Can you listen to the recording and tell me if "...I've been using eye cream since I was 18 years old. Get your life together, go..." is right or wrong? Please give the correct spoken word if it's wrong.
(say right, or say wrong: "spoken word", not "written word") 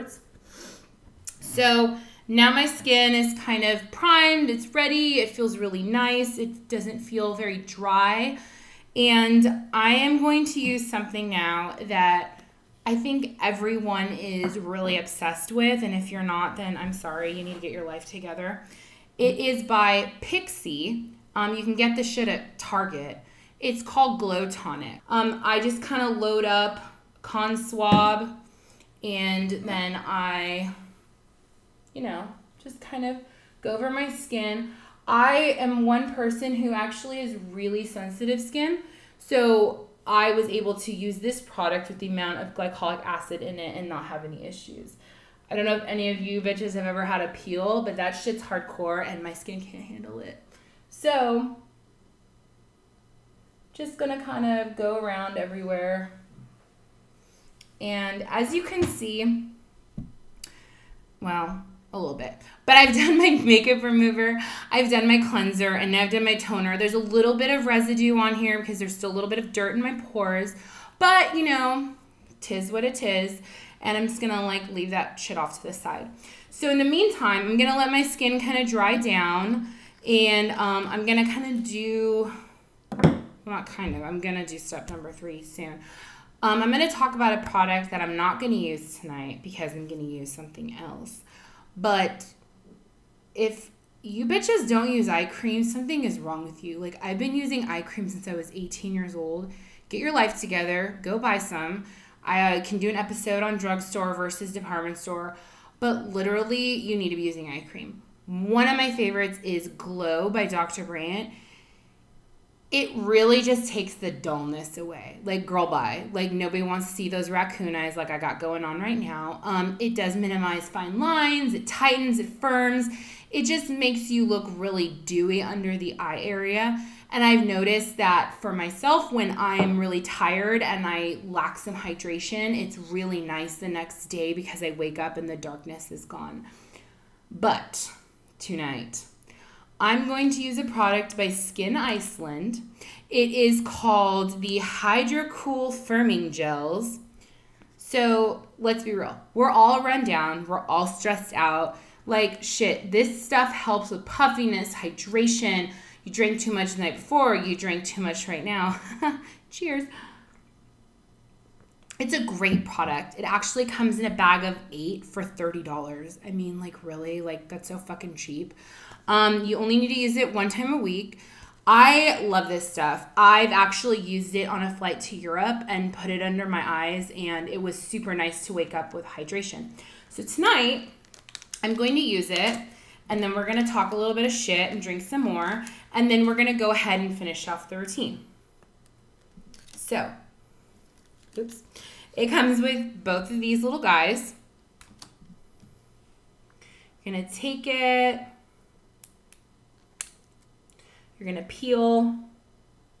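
right.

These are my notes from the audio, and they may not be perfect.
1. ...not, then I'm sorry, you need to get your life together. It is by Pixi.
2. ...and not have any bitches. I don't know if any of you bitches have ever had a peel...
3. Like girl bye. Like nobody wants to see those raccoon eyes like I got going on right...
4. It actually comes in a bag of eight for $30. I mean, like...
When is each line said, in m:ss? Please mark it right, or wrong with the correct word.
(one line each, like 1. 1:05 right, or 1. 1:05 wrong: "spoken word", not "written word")
1. 0:16 right
2. 0:43 wrong: "issues", not "bitches"
3. 1:55 right
4. 2:43 right.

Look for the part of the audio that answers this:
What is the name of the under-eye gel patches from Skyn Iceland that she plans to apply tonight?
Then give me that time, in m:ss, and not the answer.
2:24.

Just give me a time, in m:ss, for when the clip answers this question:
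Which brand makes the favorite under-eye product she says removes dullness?
1:50.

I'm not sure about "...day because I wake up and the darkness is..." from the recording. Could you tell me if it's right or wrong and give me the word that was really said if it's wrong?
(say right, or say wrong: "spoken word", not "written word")
right.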